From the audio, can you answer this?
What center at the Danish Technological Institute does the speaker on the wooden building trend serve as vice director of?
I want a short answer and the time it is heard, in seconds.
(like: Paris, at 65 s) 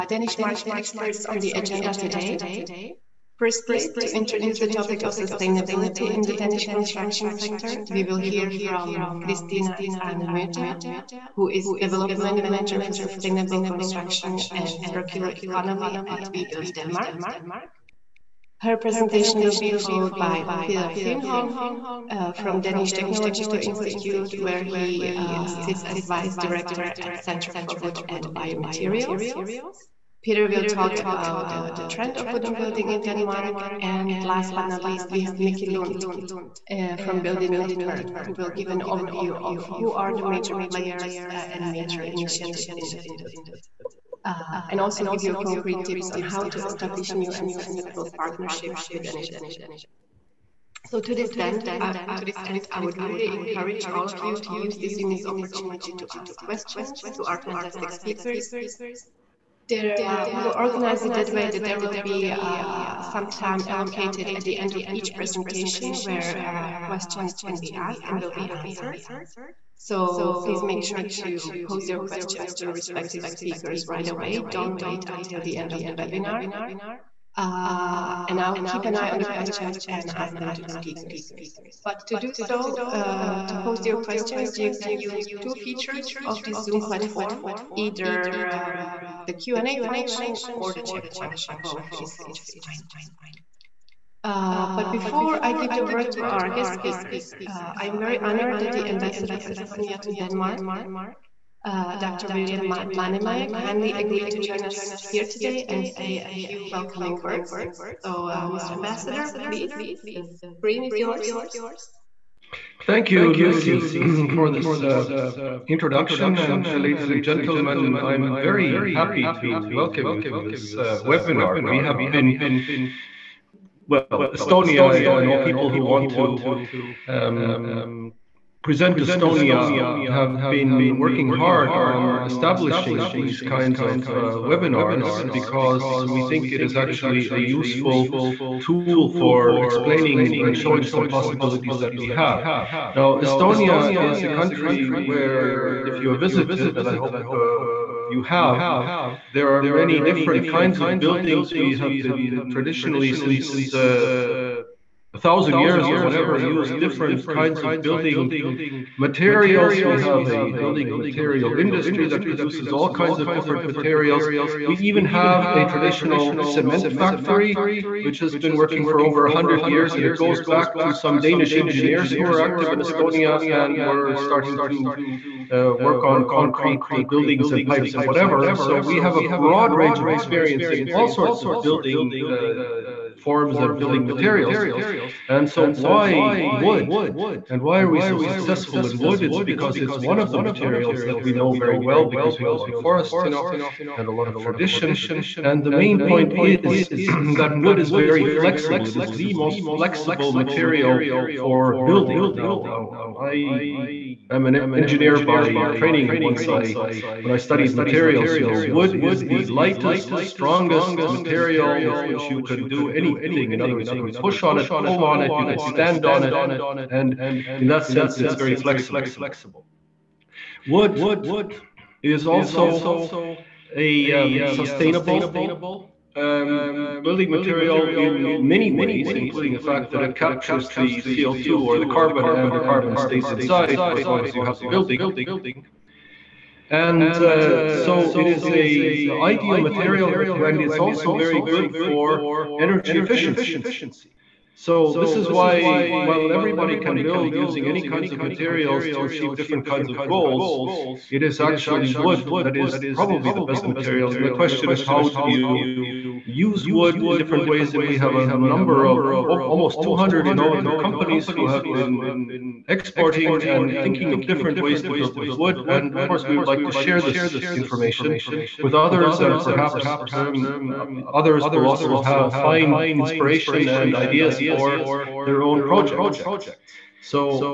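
Center for Wood and Biomaterials, at 27 s.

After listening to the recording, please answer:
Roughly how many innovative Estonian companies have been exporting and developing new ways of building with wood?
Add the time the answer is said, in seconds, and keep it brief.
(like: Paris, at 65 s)
Almost 200, at 259 s.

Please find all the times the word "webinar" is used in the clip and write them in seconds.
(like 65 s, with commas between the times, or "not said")
75 s, 121 s, 134 s.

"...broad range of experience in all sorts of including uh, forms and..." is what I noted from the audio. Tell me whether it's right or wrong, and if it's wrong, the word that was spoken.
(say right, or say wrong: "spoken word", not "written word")
wrong: "building", not "including".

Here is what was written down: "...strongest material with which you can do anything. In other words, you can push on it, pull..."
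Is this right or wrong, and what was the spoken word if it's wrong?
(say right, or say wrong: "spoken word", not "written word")
right.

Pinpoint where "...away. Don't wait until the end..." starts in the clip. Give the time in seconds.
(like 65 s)
74 s.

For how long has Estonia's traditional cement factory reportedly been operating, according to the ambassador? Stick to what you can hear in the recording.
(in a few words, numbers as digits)
Over 100 years.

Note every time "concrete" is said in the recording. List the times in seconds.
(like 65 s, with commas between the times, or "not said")
45 s, 176 s.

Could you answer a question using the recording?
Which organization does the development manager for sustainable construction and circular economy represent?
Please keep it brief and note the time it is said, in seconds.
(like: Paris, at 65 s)
WeBuild Denmark, at 16 s.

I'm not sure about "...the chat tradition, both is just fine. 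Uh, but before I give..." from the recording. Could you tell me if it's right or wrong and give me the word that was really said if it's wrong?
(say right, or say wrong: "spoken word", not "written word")
wrong: "function", not "tradition".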